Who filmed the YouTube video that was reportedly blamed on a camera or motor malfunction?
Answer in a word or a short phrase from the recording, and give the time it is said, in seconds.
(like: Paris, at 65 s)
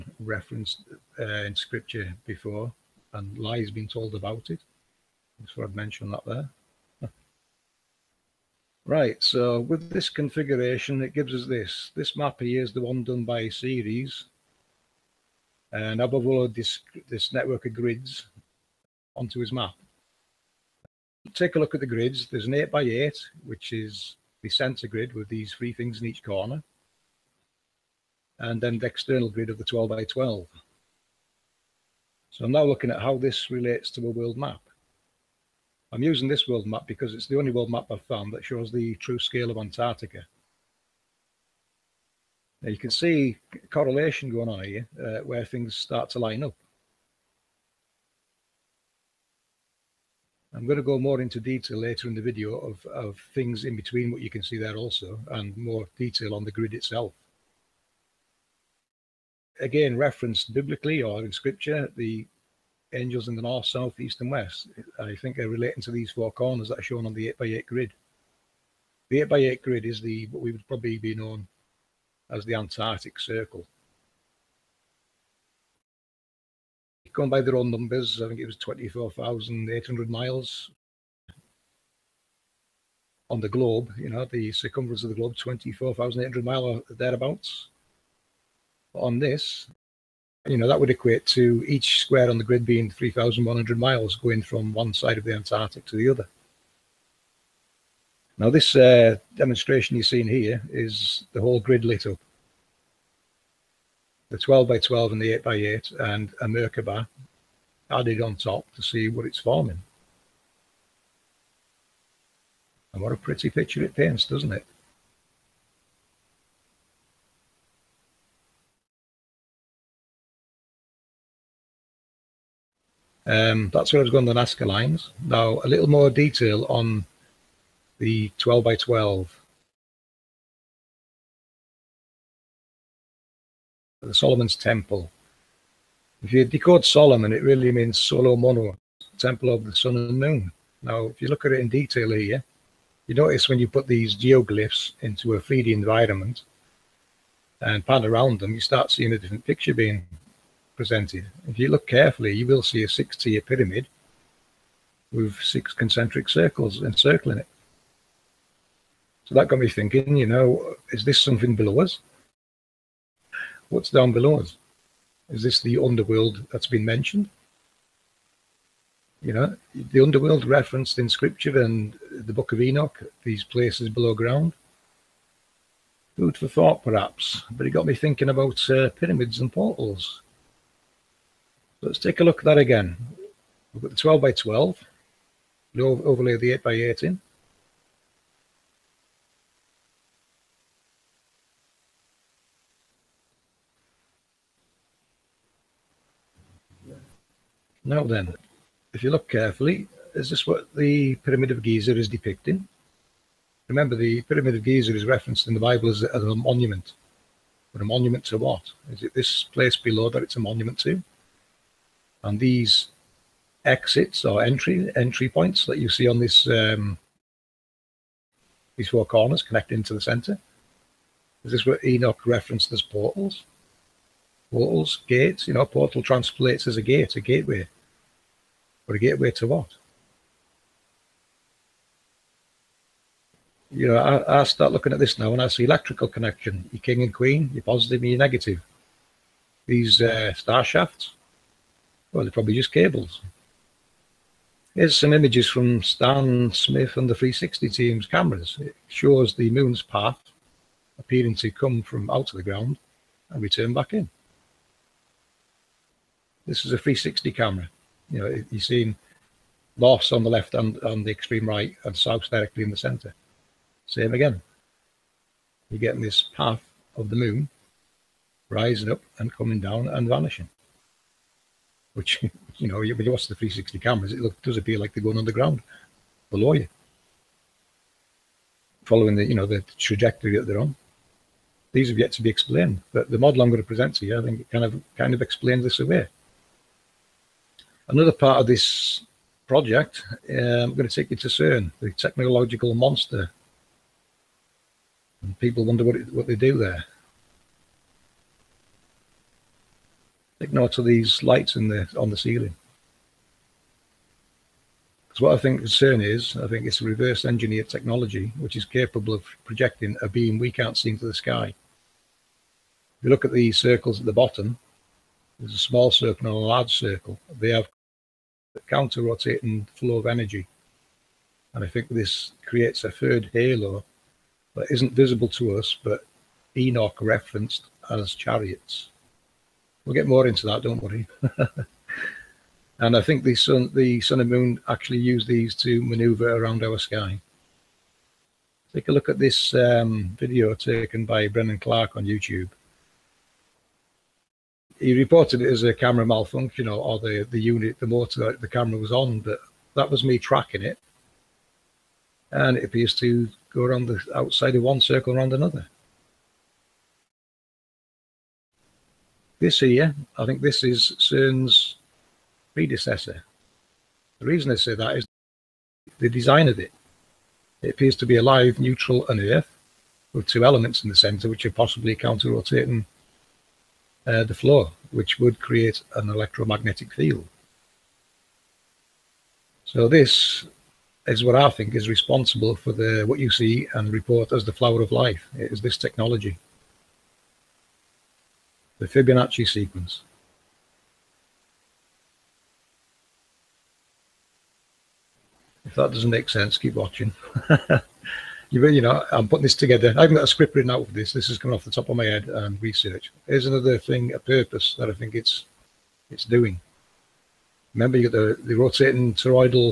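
Brennan Clark, at 341 s.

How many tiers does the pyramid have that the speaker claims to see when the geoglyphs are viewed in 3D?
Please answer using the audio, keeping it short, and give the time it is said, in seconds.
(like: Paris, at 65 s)
6, at 152 s.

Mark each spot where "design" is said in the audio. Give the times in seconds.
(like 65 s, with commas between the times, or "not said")
366 s.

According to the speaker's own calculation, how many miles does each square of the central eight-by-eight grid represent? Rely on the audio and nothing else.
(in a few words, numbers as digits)
3,100.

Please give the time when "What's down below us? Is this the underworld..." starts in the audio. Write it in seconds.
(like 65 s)
163 s.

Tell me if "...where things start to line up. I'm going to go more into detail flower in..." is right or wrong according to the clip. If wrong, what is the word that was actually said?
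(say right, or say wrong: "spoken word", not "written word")
wrong: "later", not "flower".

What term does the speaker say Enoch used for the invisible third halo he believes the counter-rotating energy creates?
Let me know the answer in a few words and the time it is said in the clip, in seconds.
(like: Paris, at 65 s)
chariots, at 328 s.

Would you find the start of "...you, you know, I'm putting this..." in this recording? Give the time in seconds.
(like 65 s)
398 s.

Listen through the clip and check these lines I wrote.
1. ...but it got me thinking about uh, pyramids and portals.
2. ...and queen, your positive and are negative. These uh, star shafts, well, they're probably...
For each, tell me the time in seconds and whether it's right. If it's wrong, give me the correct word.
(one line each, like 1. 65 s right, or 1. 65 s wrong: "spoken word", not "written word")
1. 177 s right
2. 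237 s right.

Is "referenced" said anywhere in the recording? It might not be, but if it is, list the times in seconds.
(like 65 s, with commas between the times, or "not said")
0 s, 59 s, 170 s, 205 s, 222 s, 326 s.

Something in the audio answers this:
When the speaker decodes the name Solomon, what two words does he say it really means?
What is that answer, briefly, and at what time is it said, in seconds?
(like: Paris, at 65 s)
solo mono, at 137 s.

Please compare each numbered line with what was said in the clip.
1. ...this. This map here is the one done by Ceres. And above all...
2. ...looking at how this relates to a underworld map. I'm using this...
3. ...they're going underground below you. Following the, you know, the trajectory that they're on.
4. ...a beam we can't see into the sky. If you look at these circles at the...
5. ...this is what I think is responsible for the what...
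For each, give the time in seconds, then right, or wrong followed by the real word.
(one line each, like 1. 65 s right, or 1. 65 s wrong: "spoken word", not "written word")
1. 11 s right
2. 32 s wrong: "world", not "underworld"
3. 274 s right
4. 310 s right
5. 379 s right.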